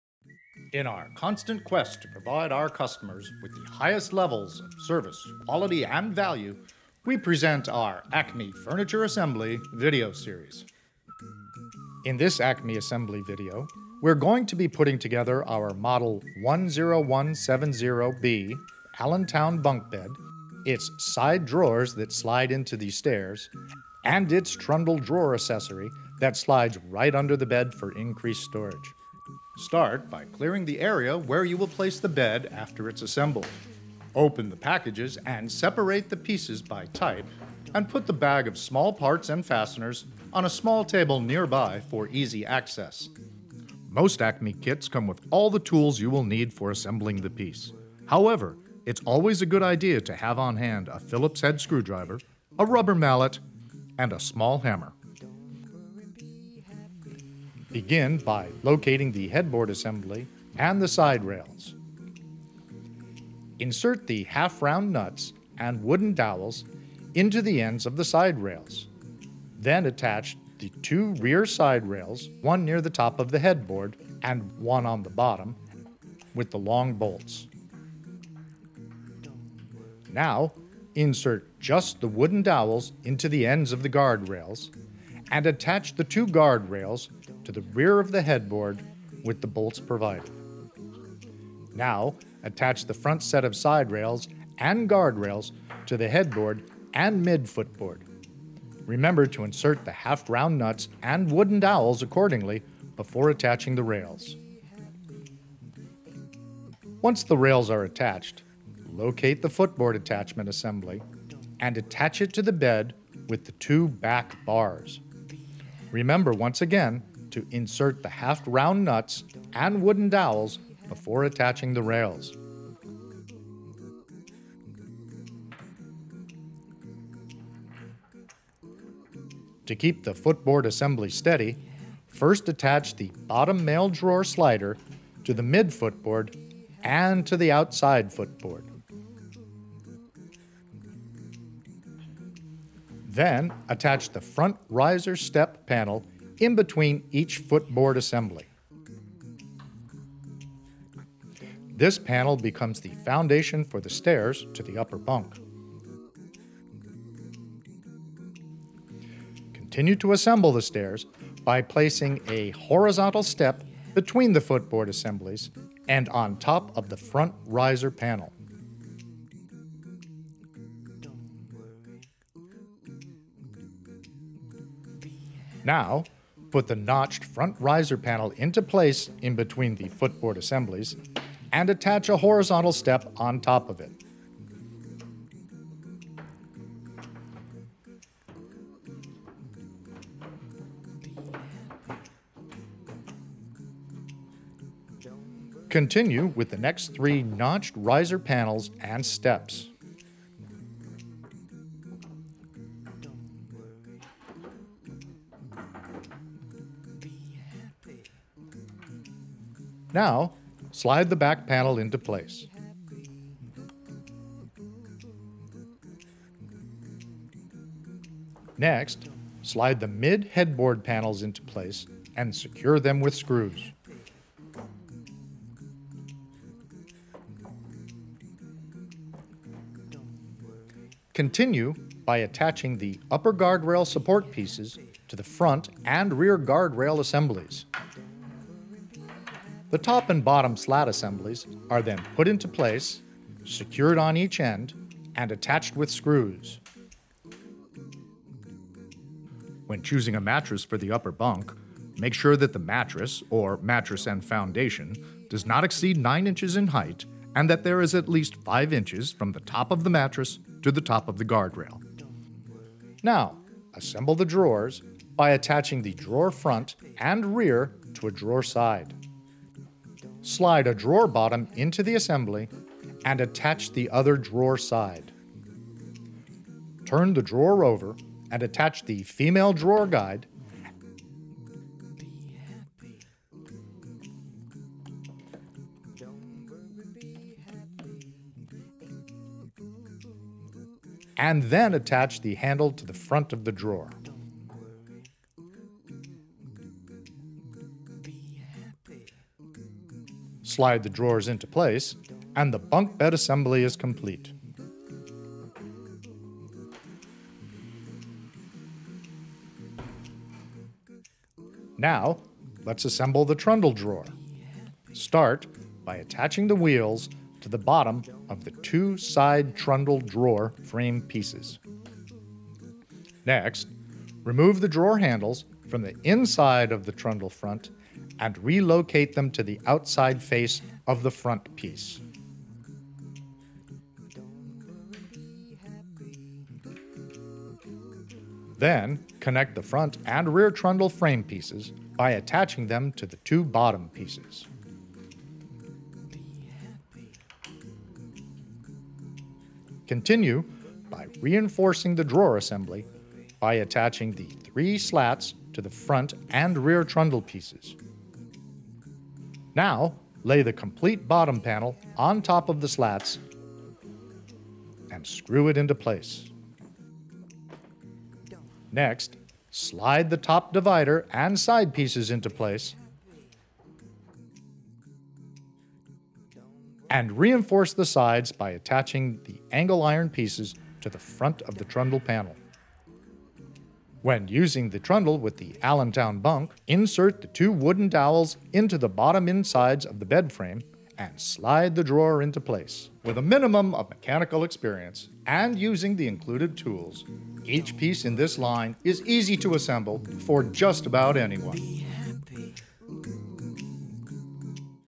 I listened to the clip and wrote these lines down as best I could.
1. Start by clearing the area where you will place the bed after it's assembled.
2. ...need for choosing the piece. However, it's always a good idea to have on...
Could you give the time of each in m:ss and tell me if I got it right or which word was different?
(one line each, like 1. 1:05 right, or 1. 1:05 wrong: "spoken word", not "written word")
1. 0:29 right
2. 0:46 wrong: "assembling", not "choosing".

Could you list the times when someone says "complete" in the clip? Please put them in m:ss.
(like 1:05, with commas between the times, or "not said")
5:03, 6:00.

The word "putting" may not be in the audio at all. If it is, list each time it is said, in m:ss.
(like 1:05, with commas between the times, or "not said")
0:14.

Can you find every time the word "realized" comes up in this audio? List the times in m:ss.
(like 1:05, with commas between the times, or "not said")
not said.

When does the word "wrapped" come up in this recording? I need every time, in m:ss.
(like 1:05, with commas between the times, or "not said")
not said.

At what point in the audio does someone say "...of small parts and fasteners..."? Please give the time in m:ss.
0:38.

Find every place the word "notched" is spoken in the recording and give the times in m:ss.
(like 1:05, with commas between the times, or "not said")
2:56, 3:17.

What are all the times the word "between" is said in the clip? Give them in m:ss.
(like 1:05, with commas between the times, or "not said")
2:26, 2:43, 2:59.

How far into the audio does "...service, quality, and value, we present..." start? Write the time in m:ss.
0:04.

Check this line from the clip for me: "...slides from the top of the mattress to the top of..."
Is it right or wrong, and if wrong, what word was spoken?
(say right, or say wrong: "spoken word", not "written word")
wrong: "inches", not "slides".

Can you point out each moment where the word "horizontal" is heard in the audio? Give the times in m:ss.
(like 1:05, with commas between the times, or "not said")
2:42, 3:02.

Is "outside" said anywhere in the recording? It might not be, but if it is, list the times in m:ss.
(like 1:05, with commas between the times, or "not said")
2:17, 5:29.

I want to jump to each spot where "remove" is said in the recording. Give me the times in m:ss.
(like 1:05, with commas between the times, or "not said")
5:24.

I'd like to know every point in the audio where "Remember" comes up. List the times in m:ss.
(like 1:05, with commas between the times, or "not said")
1:38, 1:55.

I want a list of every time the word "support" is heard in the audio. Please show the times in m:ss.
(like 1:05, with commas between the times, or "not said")
3:53.